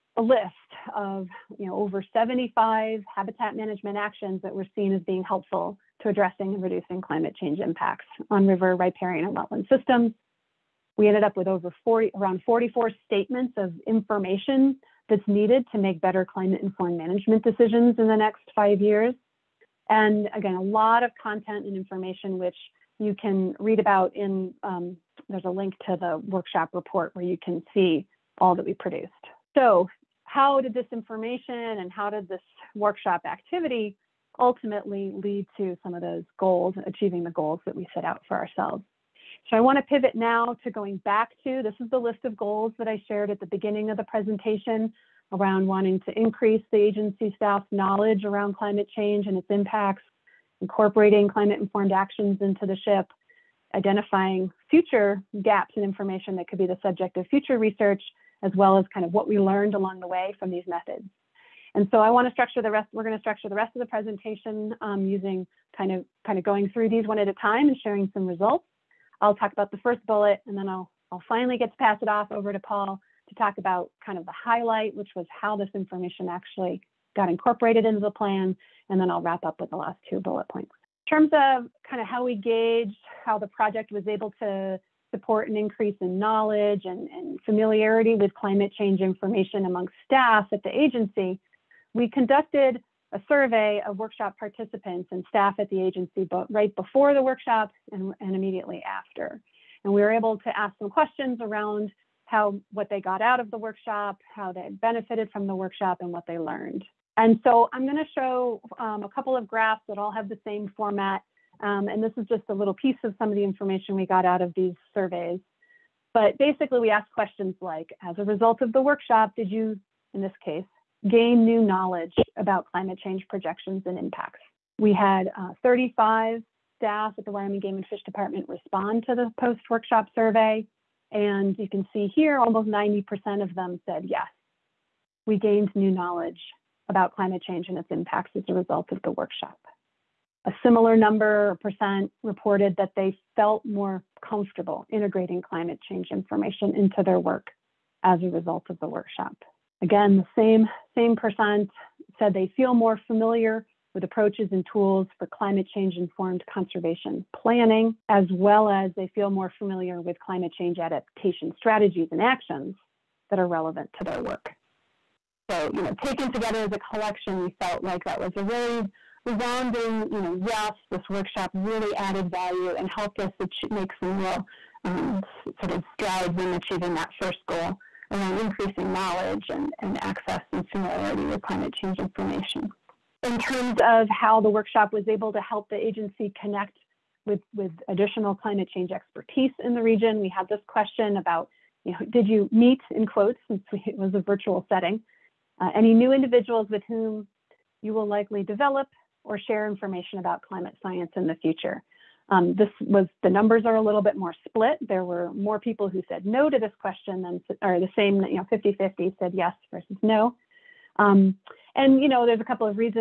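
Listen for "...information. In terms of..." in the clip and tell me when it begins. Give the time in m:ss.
3:01.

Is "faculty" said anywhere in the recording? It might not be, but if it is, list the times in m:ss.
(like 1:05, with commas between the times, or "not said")
not said.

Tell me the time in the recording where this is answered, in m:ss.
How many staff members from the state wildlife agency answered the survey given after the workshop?
2:05.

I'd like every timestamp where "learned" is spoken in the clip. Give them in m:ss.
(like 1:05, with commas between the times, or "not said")
0:59, 1:46.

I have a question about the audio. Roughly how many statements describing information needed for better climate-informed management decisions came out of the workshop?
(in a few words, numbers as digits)
44.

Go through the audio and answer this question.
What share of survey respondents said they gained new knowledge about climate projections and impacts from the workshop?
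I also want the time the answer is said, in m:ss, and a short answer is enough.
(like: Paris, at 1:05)
almost 90%, at 2:12.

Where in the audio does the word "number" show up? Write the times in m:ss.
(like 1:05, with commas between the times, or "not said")
2:20, 3:23.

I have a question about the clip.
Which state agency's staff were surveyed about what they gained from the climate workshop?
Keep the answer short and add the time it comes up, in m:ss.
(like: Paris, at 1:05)
Wyoming Game and Fish Department, at 2:07.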